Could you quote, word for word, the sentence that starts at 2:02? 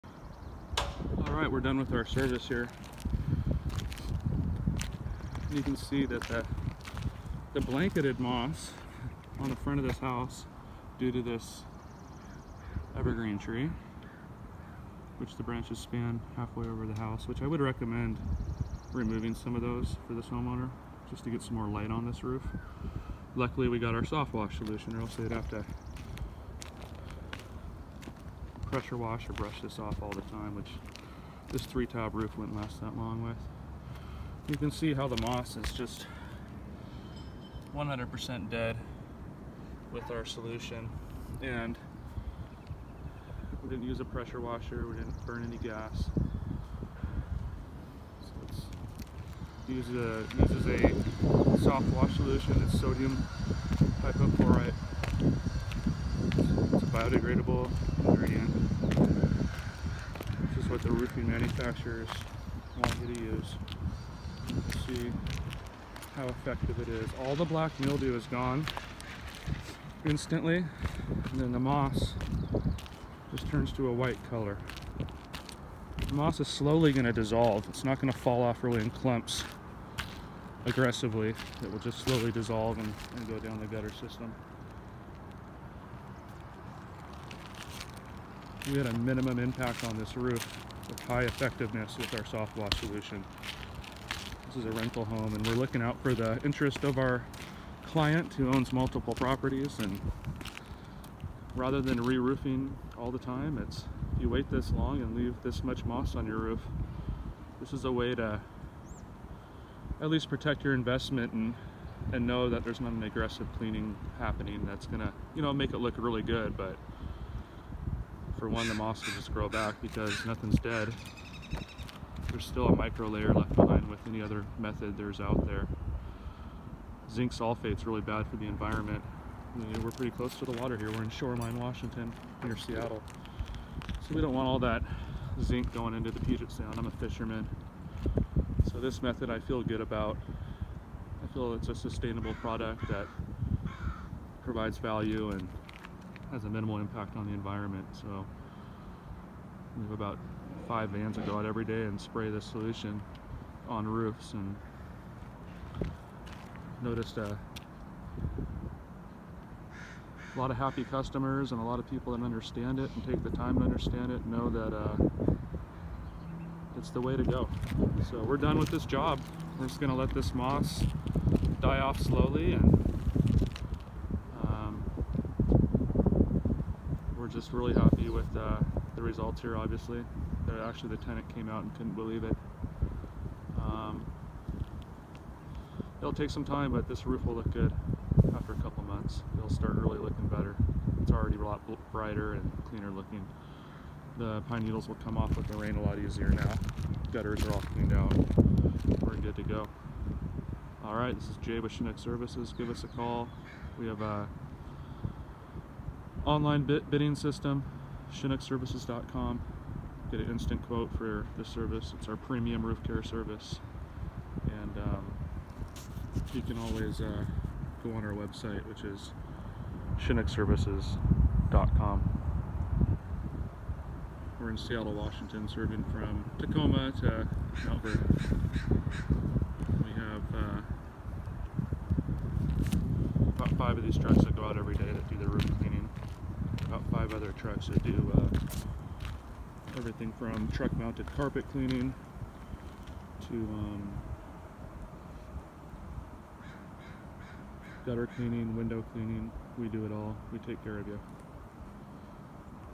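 There's still a micro layer left behind with any other method there's out there.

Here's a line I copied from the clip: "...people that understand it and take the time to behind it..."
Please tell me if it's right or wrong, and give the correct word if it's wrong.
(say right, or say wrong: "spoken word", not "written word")
wrong: "understand", not "behind".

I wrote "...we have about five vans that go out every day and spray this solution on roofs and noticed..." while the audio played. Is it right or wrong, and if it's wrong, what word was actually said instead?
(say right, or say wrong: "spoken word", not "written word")
right.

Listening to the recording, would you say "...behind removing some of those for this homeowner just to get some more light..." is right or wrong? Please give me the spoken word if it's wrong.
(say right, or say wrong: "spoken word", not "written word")
wrong: "recommend", not "behind".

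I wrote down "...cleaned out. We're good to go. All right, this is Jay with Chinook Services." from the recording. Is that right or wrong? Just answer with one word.
right.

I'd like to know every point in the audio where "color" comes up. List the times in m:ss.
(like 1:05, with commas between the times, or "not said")
1:14.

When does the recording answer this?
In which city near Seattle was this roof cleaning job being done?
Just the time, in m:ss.
2:11.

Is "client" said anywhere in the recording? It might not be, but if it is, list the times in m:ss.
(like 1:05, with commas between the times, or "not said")
1:37.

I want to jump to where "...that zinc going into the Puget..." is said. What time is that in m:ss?
2:14.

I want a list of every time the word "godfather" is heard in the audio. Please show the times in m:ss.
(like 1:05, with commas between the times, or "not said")
not said.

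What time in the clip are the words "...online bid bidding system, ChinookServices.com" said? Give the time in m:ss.
3:26.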